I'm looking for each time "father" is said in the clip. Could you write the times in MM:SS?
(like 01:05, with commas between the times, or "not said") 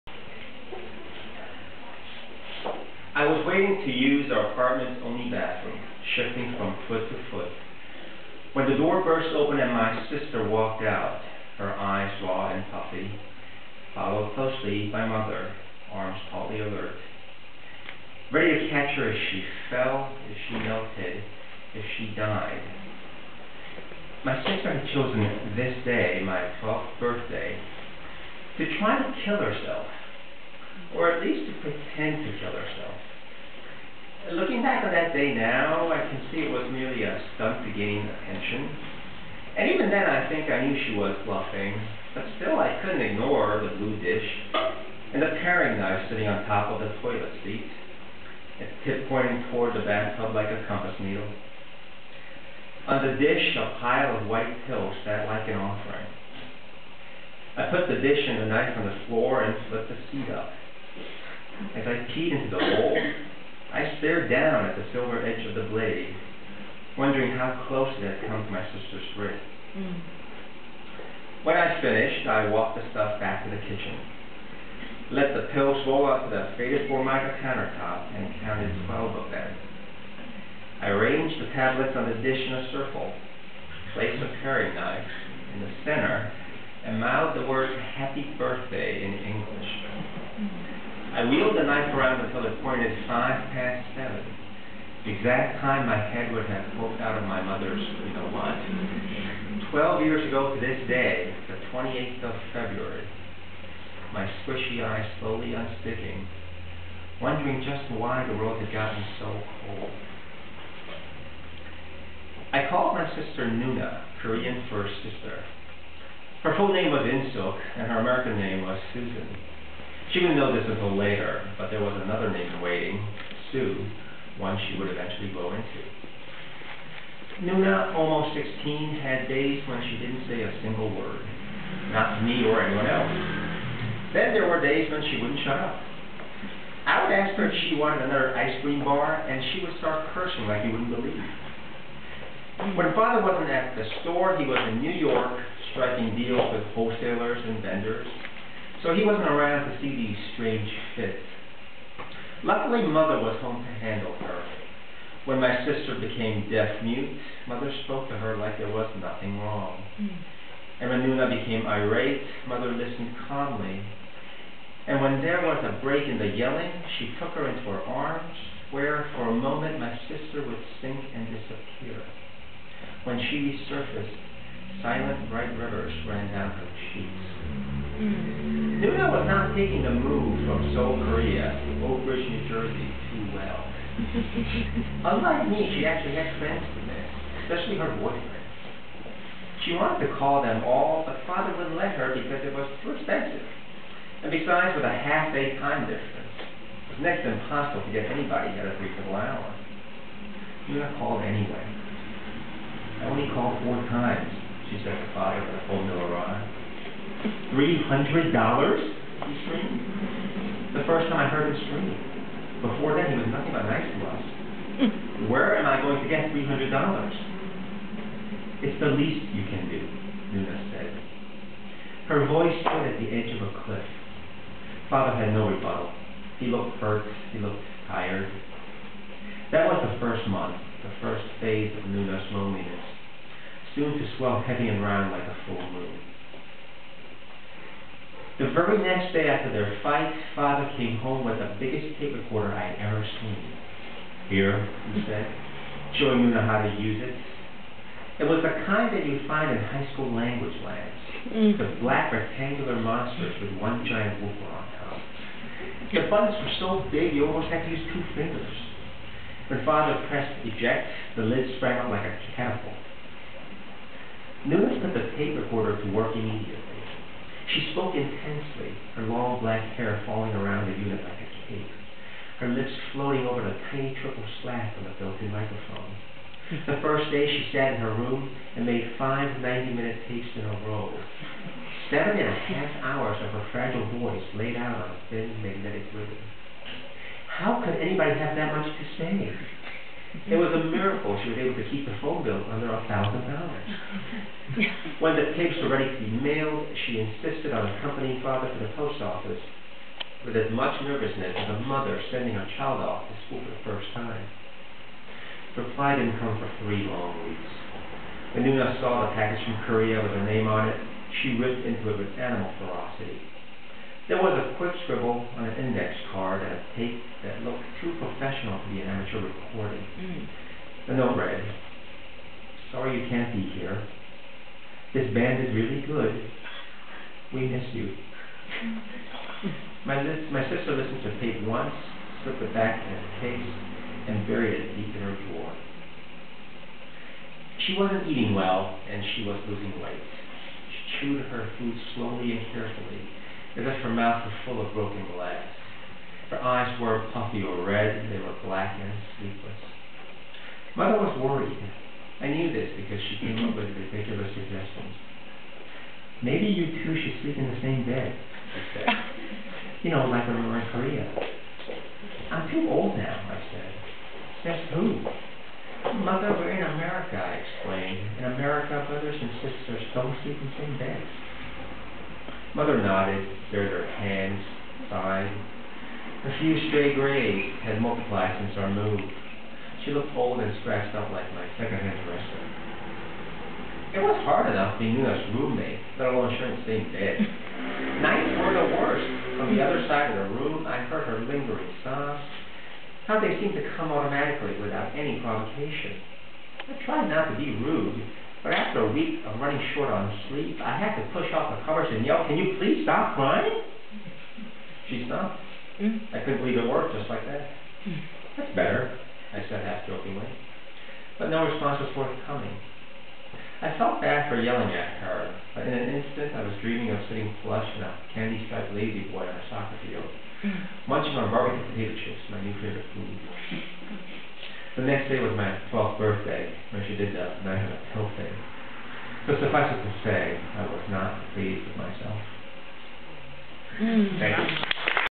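02:22, 03:11, 03:25, 03:44, 04:00, 04:19, 04:58.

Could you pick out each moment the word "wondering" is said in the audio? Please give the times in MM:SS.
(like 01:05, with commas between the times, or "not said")
01:06, 01:47.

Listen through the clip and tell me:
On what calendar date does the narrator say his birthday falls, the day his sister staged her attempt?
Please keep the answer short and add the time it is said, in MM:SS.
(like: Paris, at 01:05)
February 28, at 01:41.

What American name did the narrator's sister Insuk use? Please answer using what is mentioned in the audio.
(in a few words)
Susan.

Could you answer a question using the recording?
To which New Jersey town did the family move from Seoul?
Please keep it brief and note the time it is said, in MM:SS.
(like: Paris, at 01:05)
Old Bridge, at 03:01.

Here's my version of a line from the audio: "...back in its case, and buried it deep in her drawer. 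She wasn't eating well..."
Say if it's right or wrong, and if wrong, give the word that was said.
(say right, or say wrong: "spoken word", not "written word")
right.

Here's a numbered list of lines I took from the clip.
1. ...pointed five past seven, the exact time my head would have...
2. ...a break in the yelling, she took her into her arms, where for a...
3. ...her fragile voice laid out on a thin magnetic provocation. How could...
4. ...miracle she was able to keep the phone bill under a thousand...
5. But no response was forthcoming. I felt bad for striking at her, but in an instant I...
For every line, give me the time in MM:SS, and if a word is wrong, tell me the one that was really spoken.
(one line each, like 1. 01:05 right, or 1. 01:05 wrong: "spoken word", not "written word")
1. 01:32 right
2. 02:45 right
3. 04:43 wrong: "ribbon", not "provocation"
4. 04:50 right
5. 06:51 wrong: "yelling", not "striking".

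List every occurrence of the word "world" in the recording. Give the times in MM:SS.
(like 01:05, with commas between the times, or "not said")
01:48.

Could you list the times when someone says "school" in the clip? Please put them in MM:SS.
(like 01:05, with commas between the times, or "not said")
04:09, 05:03.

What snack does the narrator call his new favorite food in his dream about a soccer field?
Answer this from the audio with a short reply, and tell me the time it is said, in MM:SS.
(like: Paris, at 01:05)
barbecue potato chips, at 07:01.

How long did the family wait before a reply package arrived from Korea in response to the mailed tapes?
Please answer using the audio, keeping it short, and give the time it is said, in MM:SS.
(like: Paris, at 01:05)
3 weeks, at 05:06.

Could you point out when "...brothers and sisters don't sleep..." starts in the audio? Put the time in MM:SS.
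06:08.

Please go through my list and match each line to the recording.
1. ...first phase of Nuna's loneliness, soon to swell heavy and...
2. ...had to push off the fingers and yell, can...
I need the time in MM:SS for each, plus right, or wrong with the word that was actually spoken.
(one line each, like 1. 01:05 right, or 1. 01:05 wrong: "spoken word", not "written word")
1. 03:51 right
2. 06:40 wrong: "covers", not "fingers".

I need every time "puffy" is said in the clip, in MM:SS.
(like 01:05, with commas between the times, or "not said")
00:12, 05:47.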